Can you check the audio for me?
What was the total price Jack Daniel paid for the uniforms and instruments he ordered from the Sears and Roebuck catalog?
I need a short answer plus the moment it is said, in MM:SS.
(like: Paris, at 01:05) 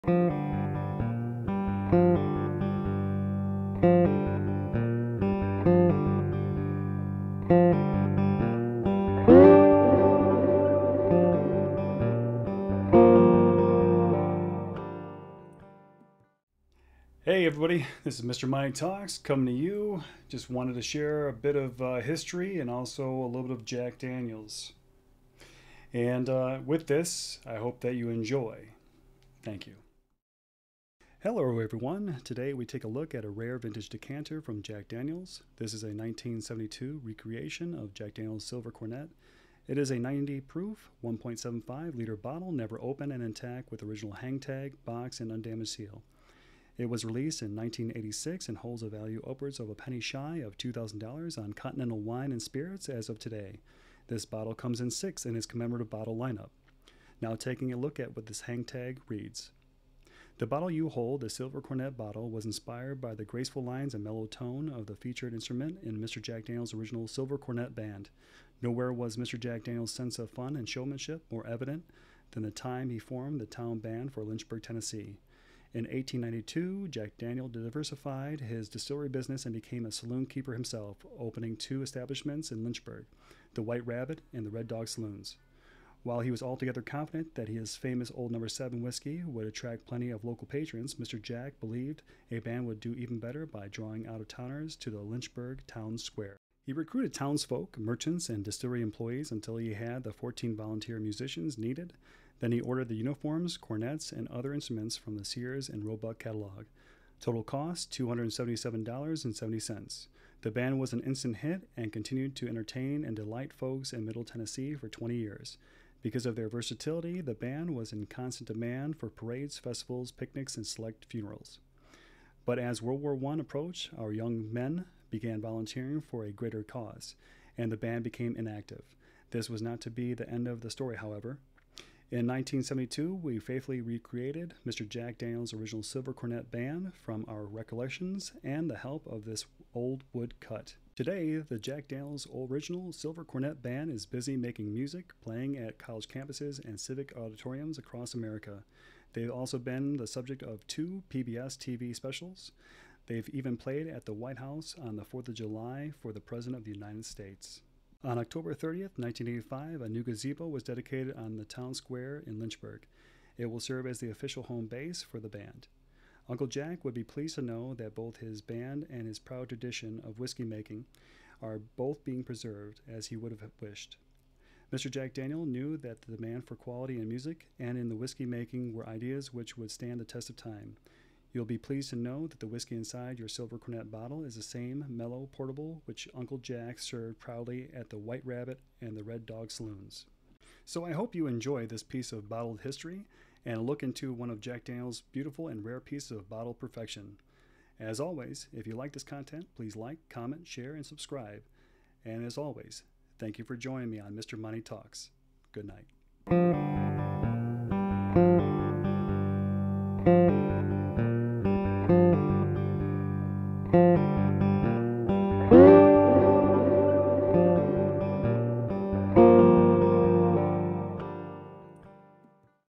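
$277.70, at 01:47.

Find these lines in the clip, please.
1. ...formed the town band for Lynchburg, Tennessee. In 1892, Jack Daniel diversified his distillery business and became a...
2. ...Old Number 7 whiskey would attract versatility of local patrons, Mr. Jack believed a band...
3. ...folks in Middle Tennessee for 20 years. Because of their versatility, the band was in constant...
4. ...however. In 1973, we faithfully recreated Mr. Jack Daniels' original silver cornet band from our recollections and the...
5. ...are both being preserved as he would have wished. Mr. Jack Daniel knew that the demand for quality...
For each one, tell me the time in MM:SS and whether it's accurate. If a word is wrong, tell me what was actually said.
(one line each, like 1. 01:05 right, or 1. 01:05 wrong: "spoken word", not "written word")
1. 01:12 right
2. 01:28 wrong: "plenty", not "versatility"
3. 01:53 right
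4. 02:10 wrong: "1972", not "1973"
5. 02:51 right.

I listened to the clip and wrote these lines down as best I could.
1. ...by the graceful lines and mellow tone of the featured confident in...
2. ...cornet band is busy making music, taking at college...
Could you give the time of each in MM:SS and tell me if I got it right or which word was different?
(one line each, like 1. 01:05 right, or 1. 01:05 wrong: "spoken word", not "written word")
1. 01:02 wrong: "instrument", not "confident"
2. 02:23 wrong: "playing", not "taking".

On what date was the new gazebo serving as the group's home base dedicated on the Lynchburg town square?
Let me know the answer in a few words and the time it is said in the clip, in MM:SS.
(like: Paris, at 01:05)
October 30, 1985, at 02:38.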